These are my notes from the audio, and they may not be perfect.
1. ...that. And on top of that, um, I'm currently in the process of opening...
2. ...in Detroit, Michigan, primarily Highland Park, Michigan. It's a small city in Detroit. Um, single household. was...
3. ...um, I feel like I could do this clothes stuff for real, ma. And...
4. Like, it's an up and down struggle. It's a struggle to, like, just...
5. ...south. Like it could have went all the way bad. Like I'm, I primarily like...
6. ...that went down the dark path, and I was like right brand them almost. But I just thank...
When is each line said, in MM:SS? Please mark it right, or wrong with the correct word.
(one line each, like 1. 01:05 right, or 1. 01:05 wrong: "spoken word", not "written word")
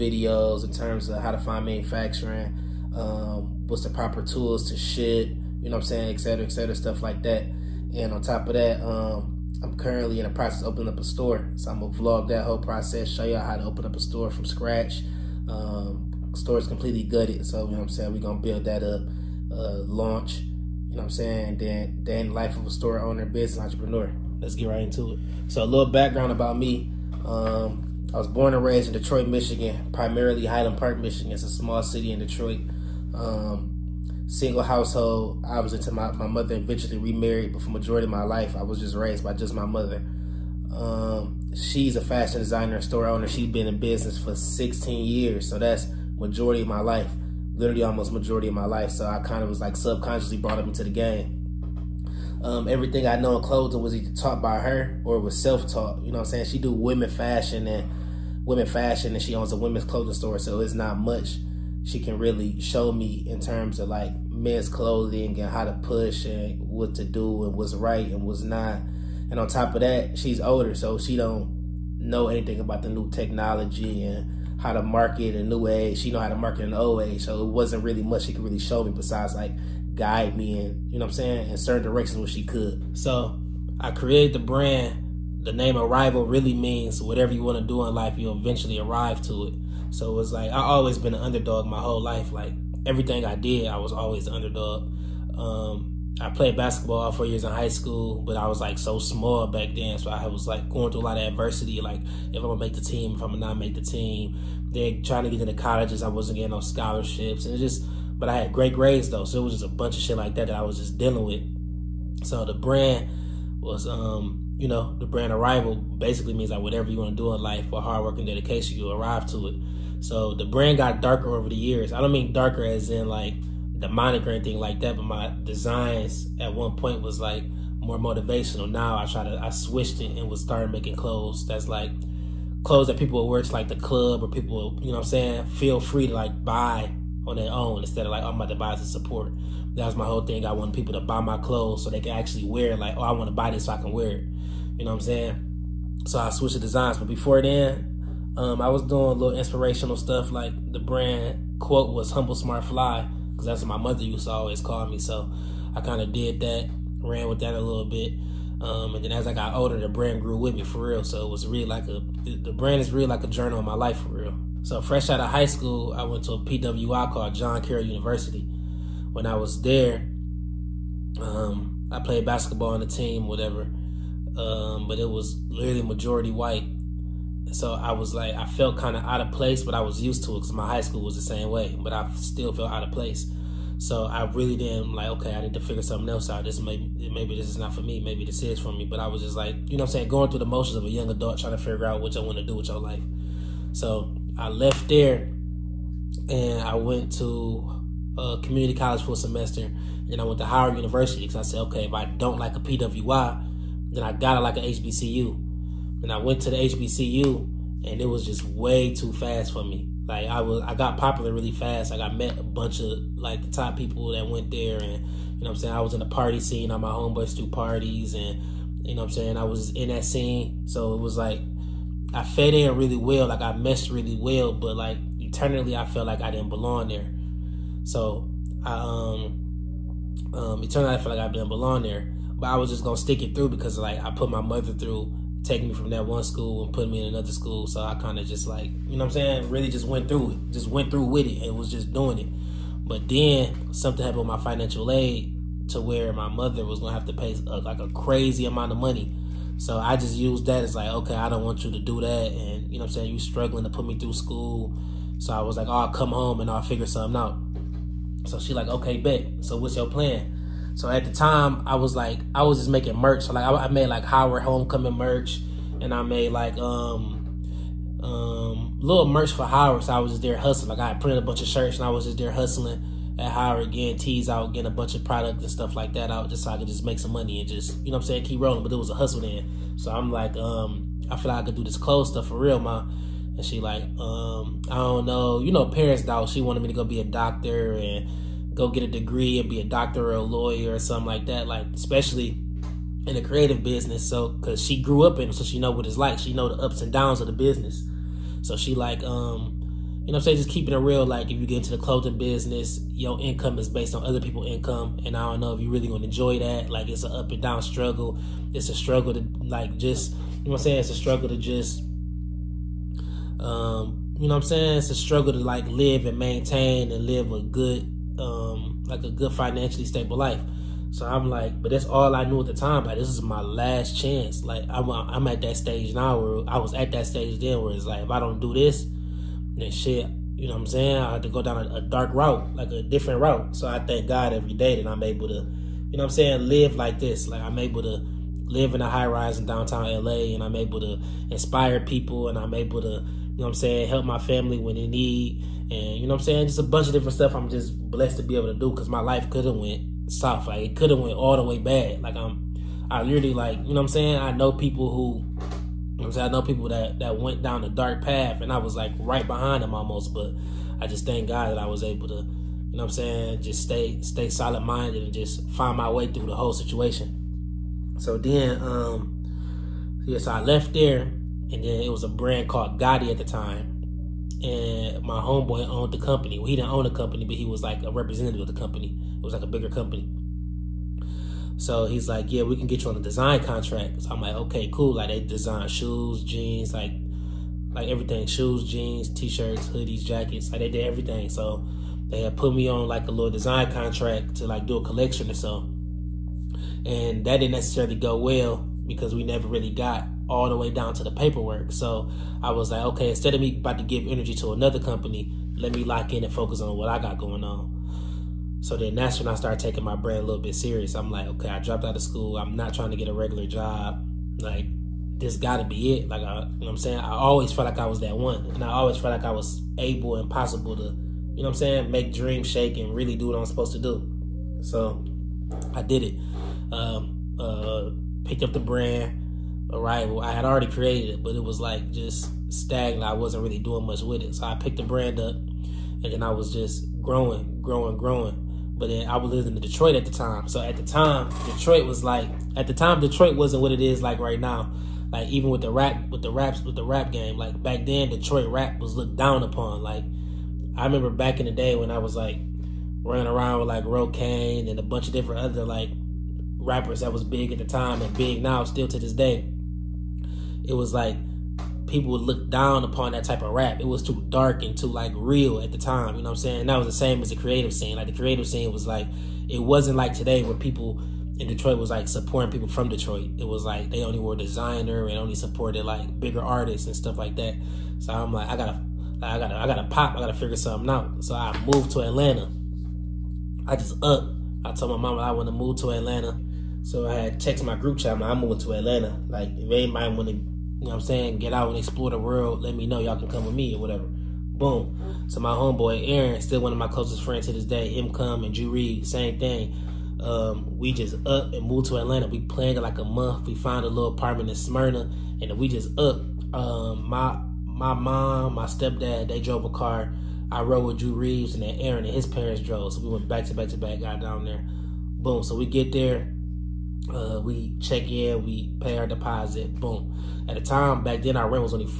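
1. 00:07 right
2. 00:28 right
3. 04:40 right
4. 05:06 right
5. 05:50 wrong: "literally", not "primarily"
6. 05:56 wrong: "behind", not "brand".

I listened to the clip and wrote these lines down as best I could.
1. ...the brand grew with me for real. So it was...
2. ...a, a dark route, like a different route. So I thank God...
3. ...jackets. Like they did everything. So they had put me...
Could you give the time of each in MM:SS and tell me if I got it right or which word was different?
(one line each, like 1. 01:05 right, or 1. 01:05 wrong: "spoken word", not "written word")
1. 02:39 right
2. 05:31 right
3. 06:30 right.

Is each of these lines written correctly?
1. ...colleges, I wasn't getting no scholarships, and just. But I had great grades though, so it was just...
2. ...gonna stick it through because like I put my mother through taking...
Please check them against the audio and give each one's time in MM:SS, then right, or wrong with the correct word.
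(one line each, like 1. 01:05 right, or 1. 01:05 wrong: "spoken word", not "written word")
1. 01:45 right
2. 03:52 right.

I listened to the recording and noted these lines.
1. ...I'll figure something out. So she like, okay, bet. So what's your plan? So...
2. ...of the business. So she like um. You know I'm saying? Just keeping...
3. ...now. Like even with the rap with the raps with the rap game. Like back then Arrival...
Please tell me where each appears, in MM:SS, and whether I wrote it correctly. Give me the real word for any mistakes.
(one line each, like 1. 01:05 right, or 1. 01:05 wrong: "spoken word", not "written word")
1. 04:16 right
2. 04:57 right
3. 07:24 wrong: "Detroit", not "Arrival".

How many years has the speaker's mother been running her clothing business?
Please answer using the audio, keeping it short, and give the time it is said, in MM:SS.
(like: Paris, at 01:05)
16, at 00:44.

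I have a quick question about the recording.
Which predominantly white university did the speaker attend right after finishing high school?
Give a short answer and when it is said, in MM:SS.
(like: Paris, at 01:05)
John Carroll University, at 02:47.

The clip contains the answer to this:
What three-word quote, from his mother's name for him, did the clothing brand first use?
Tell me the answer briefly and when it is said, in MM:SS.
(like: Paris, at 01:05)
Humble Smart Fly, at 02:32.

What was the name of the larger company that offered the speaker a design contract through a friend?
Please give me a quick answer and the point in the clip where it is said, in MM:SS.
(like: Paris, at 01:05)
Gotti, at 06:12.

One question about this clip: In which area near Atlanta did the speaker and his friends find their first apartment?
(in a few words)
Smyrna.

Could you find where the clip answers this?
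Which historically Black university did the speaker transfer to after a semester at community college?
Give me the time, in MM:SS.
03:20.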